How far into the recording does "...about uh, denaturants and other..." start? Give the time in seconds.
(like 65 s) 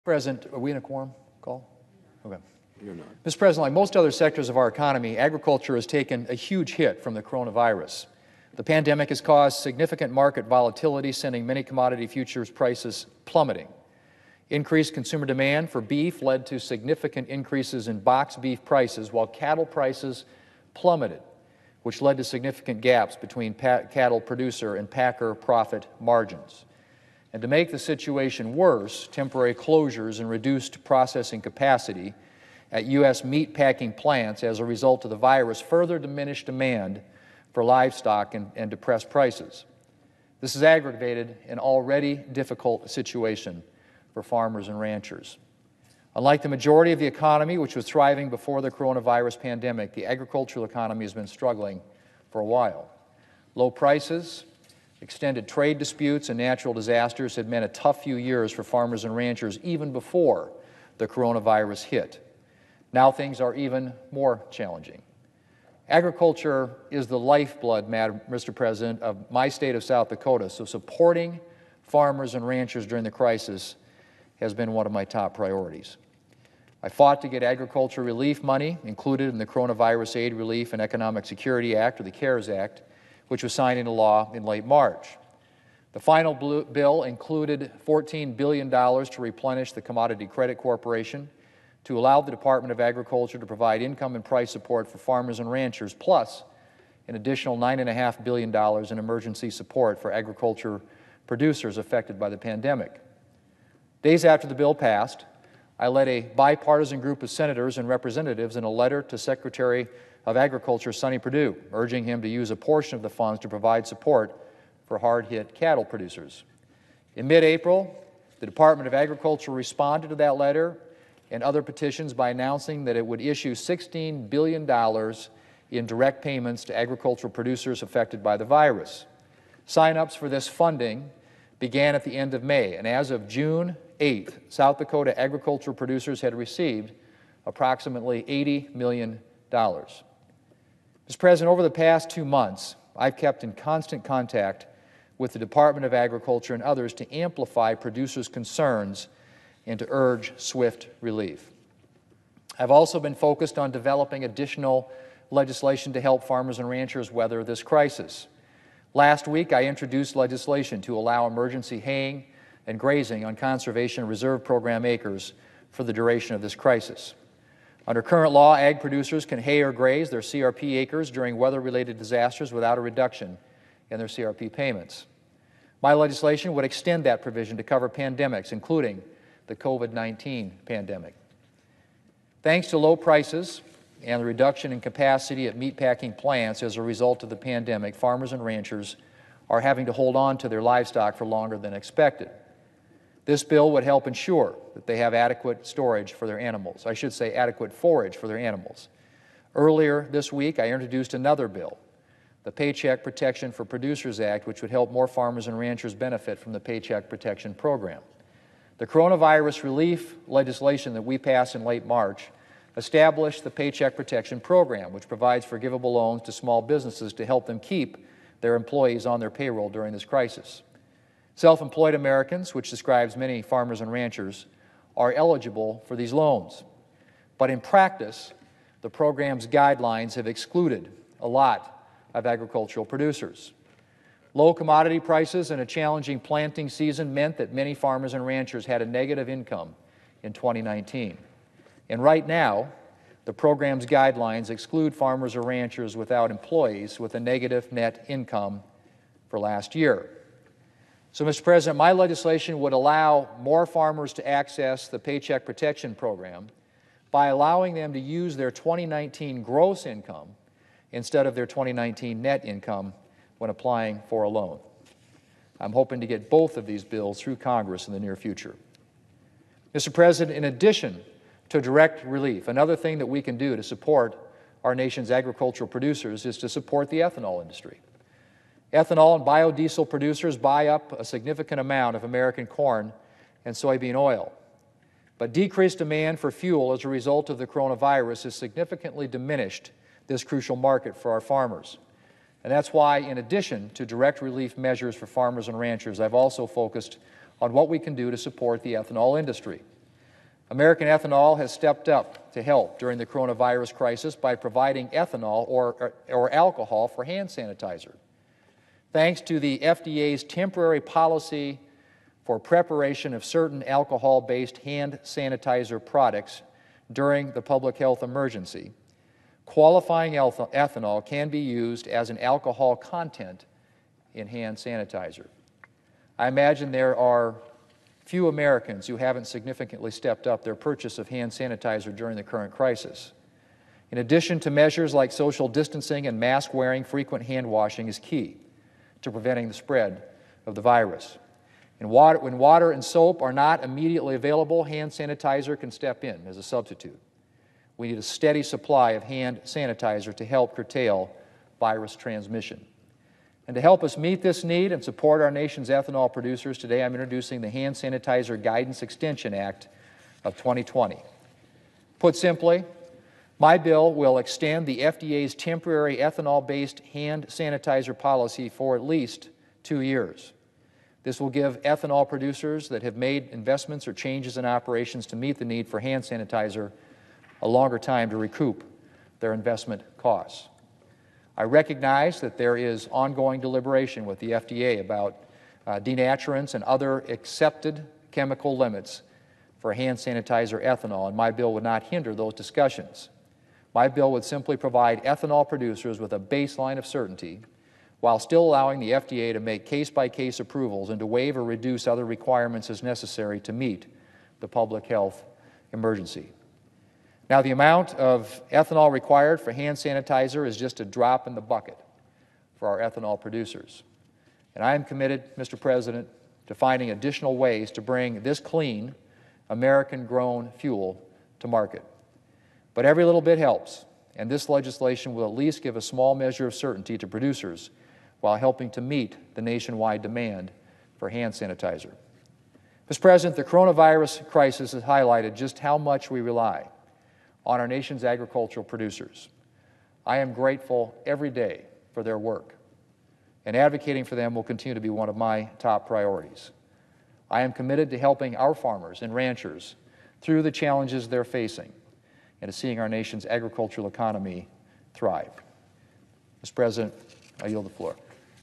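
384 s.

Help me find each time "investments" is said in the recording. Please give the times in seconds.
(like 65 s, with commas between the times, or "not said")
373 s, 379 s.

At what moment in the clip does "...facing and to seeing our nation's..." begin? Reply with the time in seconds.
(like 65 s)
451 s.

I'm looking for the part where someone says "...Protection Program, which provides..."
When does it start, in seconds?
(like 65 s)
213 s.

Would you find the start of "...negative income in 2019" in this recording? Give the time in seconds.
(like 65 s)
238 s.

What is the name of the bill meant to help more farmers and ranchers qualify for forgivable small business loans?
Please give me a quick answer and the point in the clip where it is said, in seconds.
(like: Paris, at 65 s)
Paycheck Protection for Producers Act, at 202 s.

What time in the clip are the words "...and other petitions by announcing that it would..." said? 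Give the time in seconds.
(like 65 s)
121 s.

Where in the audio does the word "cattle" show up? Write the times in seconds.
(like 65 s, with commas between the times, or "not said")
19 s, 23 s, 115 s.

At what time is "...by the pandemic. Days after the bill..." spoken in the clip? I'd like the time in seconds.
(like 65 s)
102 s.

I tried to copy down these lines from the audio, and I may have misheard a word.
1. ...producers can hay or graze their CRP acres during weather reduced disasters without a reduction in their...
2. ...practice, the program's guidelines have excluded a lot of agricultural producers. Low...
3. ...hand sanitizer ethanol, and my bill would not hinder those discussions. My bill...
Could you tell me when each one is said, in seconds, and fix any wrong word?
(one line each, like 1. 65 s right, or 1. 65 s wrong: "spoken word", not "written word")
1. 168 s wrong: "related", not "reduced"
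2. 227 s right
3. 389 s right.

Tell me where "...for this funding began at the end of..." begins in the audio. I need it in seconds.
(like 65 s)
130 s.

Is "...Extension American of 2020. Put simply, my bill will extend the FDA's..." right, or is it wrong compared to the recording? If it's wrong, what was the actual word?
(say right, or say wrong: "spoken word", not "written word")
wrong: "Act", not "American".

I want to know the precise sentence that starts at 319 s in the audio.
Qualifying ethanol can be used as an alcohol content in hand sanitizer.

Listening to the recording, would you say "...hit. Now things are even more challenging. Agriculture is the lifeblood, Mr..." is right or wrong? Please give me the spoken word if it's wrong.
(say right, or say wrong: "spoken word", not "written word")
right.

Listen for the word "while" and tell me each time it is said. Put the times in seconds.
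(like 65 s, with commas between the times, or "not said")
19 s, 52 s, 398 s, 428 s.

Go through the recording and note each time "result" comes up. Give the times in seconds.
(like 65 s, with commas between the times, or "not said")
34 s, 186 s, 286 s.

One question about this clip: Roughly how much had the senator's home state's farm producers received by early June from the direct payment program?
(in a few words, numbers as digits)
$80 million.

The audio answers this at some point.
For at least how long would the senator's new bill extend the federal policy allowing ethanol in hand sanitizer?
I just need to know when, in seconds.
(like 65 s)
369 s.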